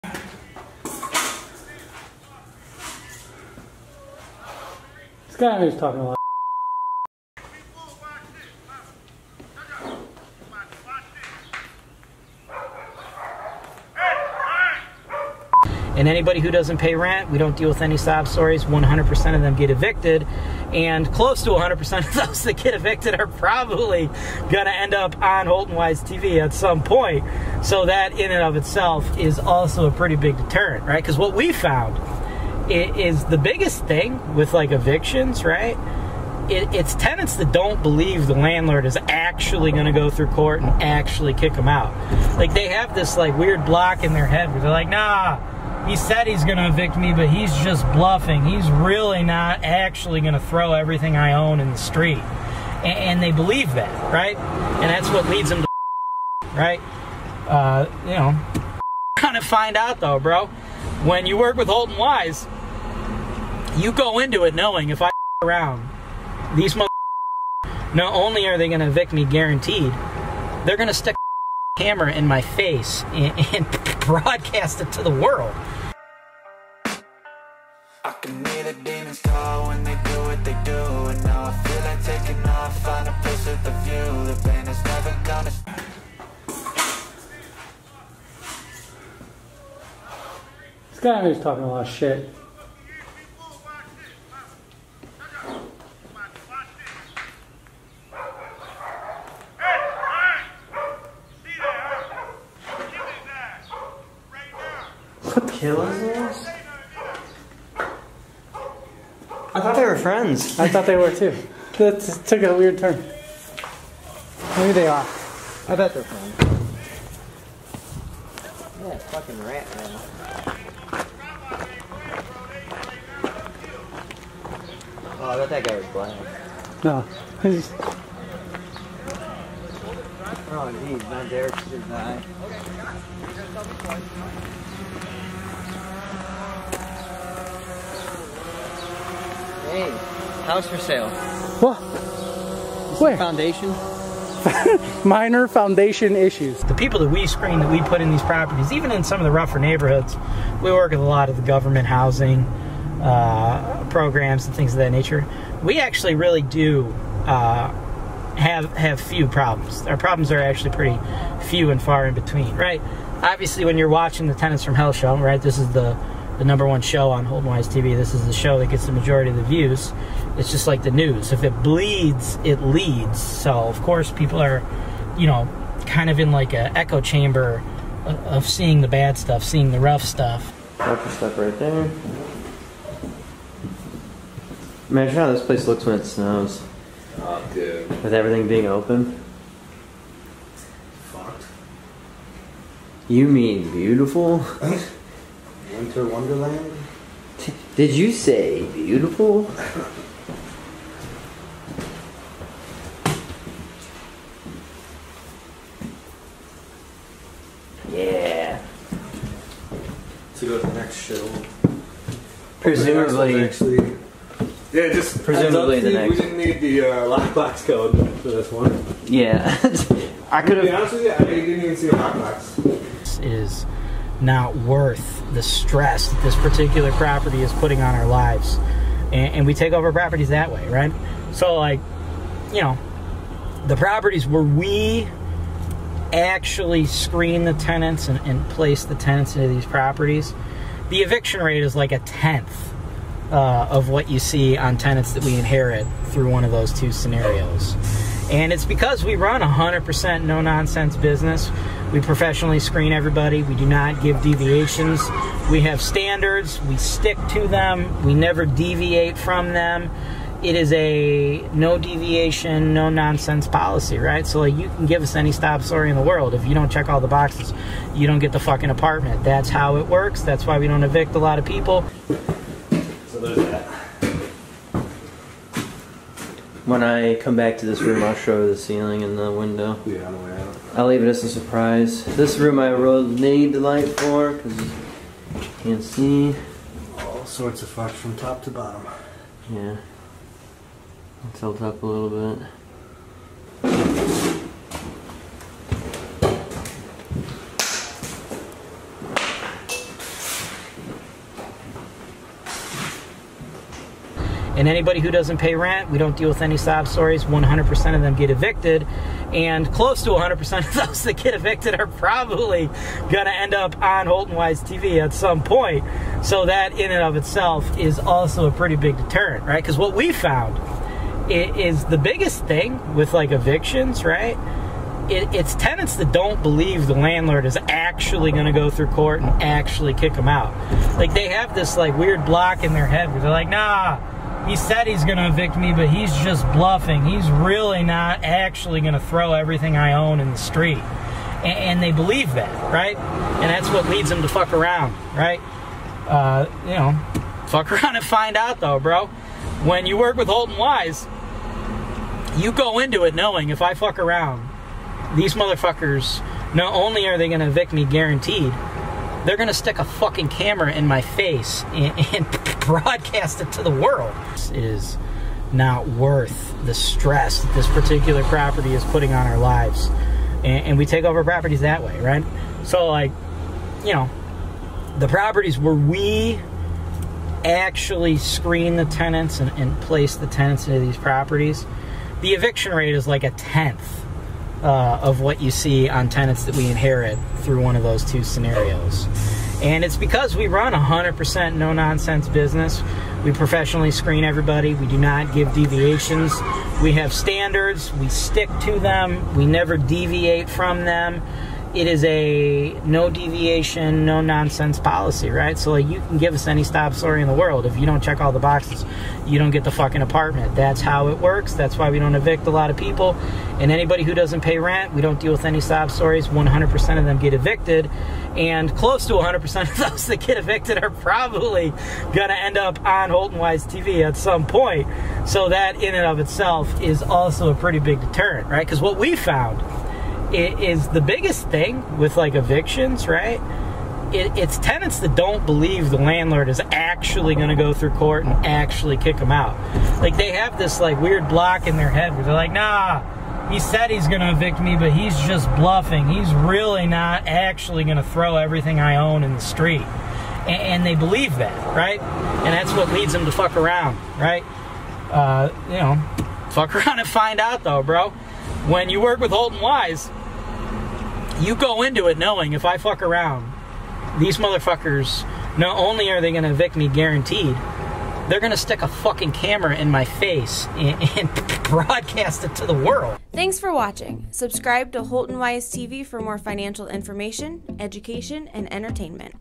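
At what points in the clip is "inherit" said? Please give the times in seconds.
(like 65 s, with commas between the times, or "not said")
245 s, 386 s.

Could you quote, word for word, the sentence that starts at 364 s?
This is not worth the stress that this particular property is putting on our lives.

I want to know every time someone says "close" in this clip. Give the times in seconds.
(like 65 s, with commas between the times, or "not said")
21 s, 309 s, 418 s.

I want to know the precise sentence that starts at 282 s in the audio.
This room I really need the light for because you can't see.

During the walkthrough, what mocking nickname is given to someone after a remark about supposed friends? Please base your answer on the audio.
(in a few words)
rat man.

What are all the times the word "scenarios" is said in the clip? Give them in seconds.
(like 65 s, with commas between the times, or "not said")
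246 s, 388 s.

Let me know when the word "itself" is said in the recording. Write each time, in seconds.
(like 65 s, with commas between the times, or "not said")
28 s, 317 s, 426 s.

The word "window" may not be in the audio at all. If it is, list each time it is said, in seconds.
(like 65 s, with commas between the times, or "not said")
279 s.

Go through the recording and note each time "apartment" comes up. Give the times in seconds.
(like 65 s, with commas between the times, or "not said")
268 s, 410 s.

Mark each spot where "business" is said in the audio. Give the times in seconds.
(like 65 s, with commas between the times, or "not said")
250 s, 392 s.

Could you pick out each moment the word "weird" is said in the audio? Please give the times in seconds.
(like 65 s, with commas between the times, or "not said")
43 s, 112 s, 331 s, 441 s.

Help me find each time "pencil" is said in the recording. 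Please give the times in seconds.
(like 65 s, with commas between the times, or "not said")
not said.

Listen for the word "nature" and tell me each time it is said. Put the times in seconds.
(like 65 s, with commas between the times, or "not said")
154 s.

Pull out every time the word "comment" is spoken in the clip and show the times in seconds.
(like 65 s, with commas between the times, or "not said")
not said.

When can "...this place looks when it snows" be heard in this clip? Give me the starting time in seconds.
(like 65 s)
185 s.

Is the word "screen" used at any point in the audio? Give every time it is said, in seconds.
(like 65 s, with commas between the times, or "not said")
147 s, 236 s, 252 s, 378 s, 393 s.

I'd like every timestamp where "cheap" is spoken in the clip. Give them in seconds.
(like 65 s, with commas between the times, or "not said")
not said.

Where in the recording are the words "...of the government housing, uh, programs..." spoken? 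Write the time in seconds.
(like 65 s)
151 s.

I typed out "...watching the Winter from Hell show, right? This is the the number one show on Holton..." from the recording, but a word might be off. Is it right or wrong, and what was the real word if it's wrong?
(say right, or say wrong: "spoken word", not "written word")
wrong: "Tenants", not "Winter".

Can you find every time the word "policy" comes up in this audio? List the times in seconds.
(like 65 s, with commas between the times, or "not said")
263 s, 404 s.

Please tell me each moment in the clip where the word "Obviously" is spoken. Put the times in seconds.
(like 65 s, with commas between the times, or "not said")
163 s.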